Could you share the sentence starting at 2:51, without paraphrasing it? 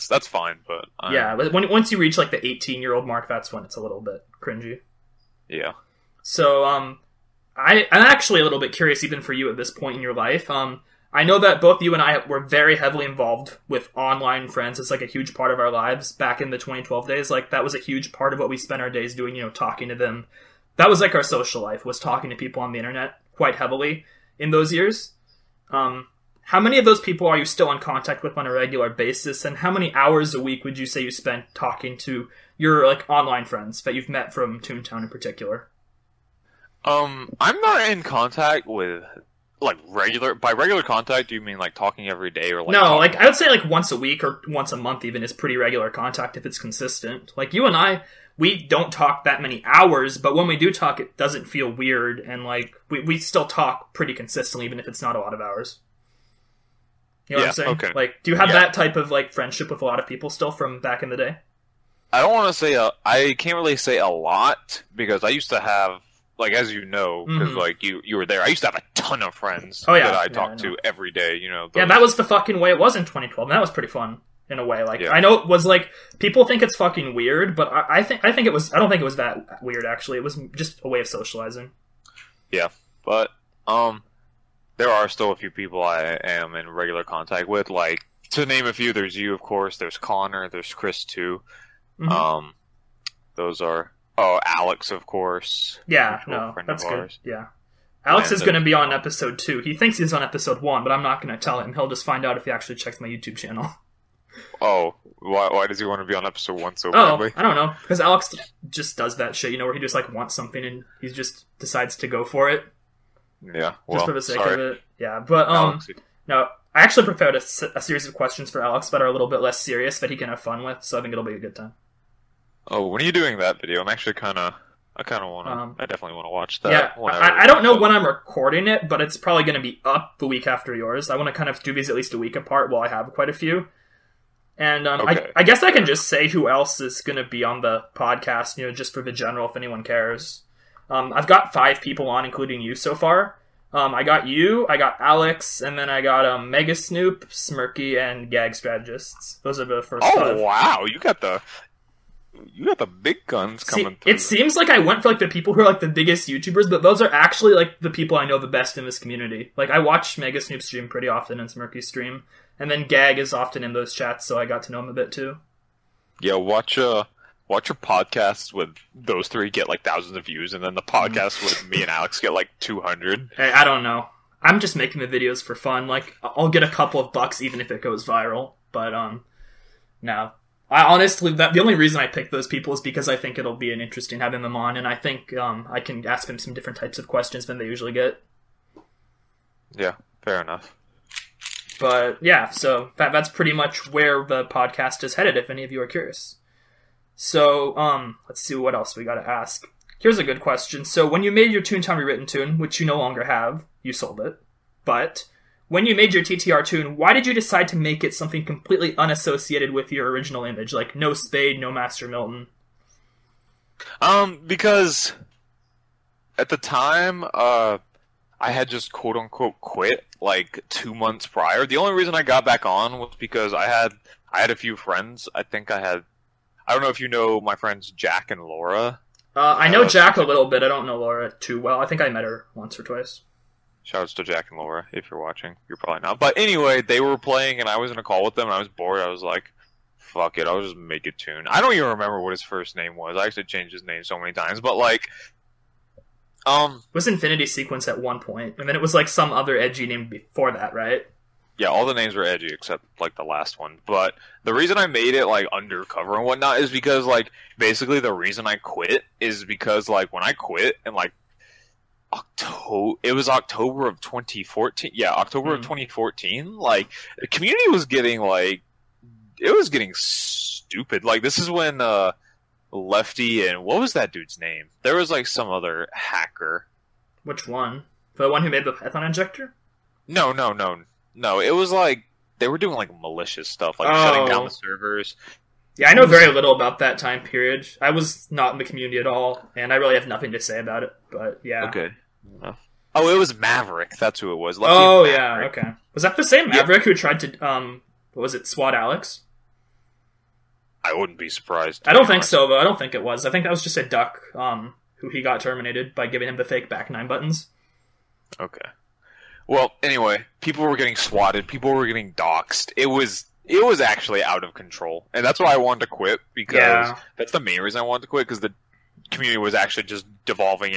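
podcast with me and Alex get like two hundred.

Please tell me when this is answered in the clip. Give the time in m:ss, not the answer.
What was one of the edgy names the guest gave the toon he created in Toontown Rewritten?
4:07.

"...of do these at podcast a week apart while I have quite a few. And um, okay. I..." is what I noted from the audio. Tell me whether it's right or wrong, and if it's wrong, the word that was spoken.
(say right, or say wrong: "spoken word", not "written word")
wrong: "least", not "podcast".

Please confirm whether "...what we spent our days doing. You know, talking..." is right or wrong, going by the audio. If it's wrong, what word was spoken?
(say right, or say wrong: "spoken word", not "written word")
right.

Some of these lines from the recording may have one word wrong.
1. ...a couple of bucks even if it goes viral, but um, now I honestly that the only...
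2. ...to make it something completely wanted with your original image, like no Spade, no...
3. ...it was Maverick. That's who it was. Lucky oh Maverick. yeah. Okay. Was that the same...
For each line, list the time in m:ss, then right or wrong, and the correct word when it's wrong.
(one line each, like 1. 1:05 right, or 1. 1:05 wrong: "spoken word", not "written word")
1. 2:56 right
2. 3:27 wrong: "unassociated", not "wanted"
3. 4:53 right.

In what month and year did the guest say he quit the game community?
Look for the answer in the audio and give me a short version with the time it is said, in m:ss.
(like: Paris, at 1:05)
October 2014, at 4:23.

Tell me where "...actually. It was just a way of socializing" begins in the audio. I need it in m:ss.
1:19.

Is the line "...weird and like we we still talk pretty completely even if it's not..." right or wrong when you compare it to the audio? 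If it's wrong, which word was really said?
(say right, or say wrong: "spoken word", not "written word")
wrong: "consistently", not "completely".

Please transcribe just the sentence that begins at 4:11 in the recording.
Yeah, all the names were edgy except like the last one.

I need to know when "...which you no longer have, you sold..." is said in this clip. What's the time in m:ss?
3:22.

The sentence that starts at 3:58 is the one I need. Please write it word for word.
I was like, fuck it, I'll just make a toon.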